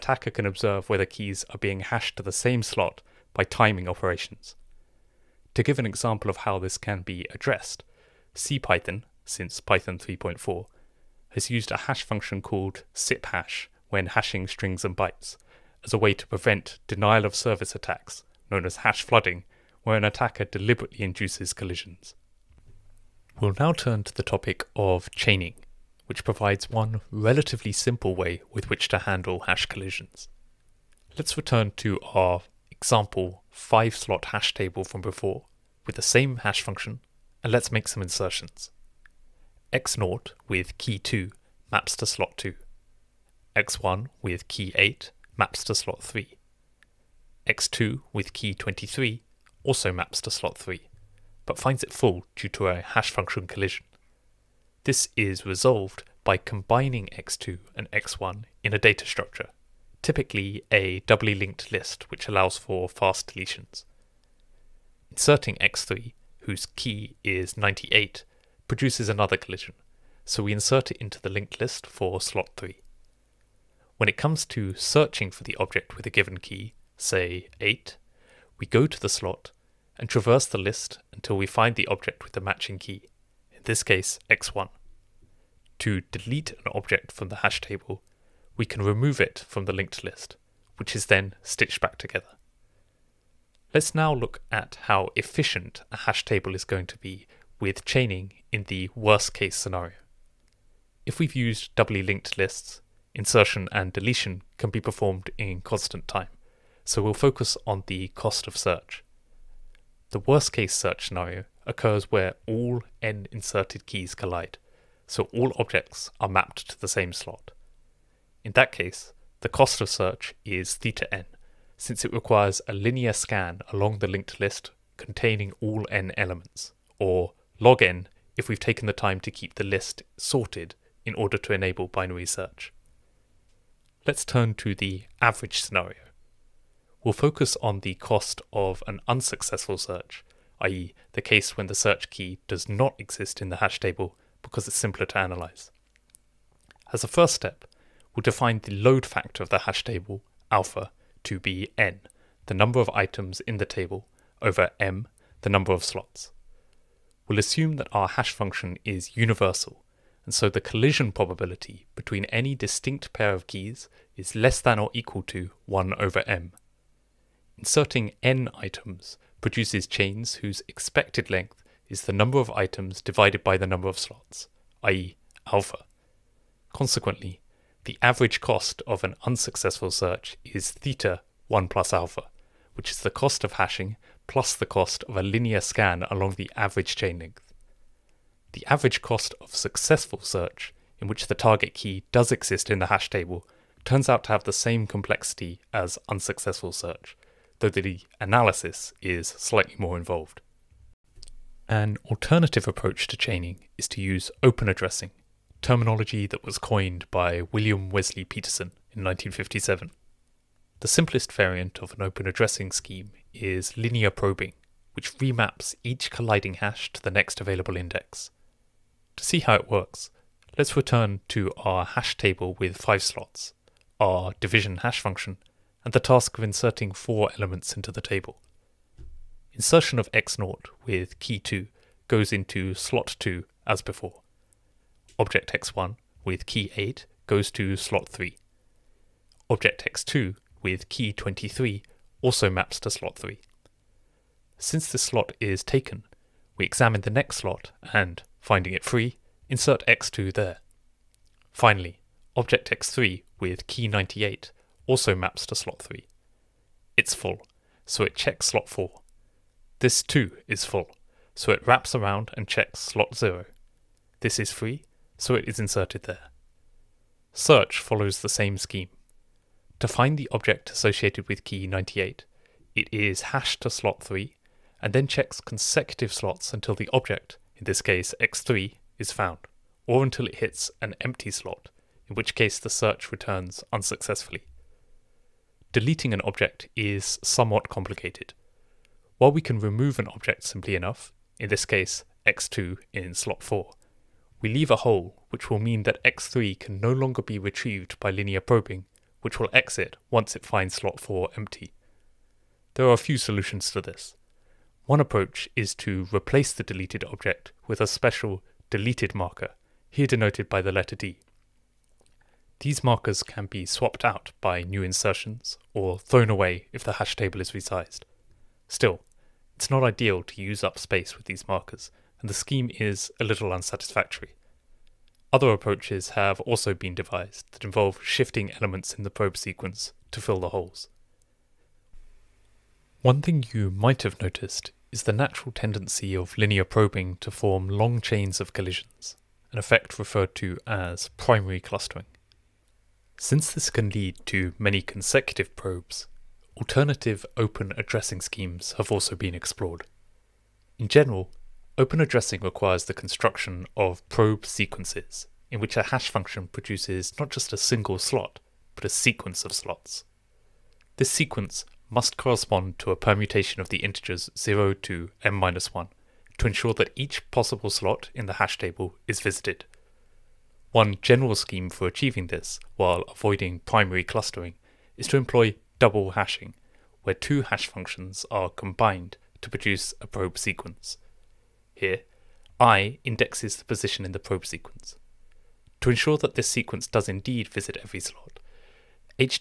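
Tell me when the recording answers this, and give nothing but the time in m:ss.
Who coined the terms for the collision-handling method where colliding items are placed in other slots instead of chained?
3:27.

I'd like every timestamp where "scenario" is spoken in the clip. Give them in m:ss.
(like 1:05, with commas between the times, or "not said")
1:39, 1:51, 2:15.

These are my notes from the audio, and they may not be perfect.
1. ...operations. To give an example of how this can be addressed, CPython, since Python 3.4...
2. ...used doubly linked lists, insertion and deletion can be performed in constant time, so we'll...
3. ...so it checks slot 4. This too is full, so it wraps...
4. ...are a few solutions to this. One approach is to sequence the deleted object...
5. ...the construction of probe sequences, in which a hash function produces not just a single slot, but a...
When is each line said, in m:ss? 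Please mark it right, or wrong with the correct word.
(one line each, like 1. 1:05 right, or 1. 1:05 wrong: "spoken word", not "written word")
1. 0:03 right
2. 1:41 right
3. 4:17 right
4. 5:02 wrong: "replace", not "sequence"
5. 5:52 right.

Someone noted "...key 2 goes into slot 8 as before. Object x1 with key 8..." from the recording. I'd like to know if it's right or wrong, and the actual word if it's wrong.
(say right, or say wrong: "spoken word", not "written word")
wrong: "2", not "8".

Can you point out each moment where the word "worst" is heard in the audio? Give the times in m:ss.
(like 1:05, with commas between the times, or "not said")
1:38, 1:50.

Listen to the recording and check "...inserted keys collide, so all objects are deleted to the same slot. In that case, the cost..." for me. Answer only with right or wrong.
wrong.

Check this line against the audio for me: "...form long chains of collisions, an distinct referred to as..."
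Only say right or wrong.
wrong.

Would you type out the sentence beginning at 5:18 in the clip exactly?
Still, it's not ideal to use up space with these markers, and the scheme is a little unsatisfactory.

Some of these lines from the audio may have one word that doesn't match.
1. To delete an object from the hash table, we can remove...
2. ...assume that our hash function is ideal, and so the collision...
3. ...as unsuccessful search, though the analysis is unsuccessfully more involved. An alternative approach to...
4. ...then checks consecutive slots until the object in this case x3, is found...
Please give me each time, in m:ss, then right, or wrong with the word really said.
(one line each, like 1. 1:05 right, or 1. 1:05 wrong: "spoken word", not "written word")
1. 1:25 right
2. 2:37 wrong: "universal", not "ideal"
3. 3:15 wrong: "slightly", not "unsuccessfully"
4. 4:34 right.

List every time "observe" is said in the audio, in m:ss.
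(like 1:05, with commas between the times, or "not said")
0:00.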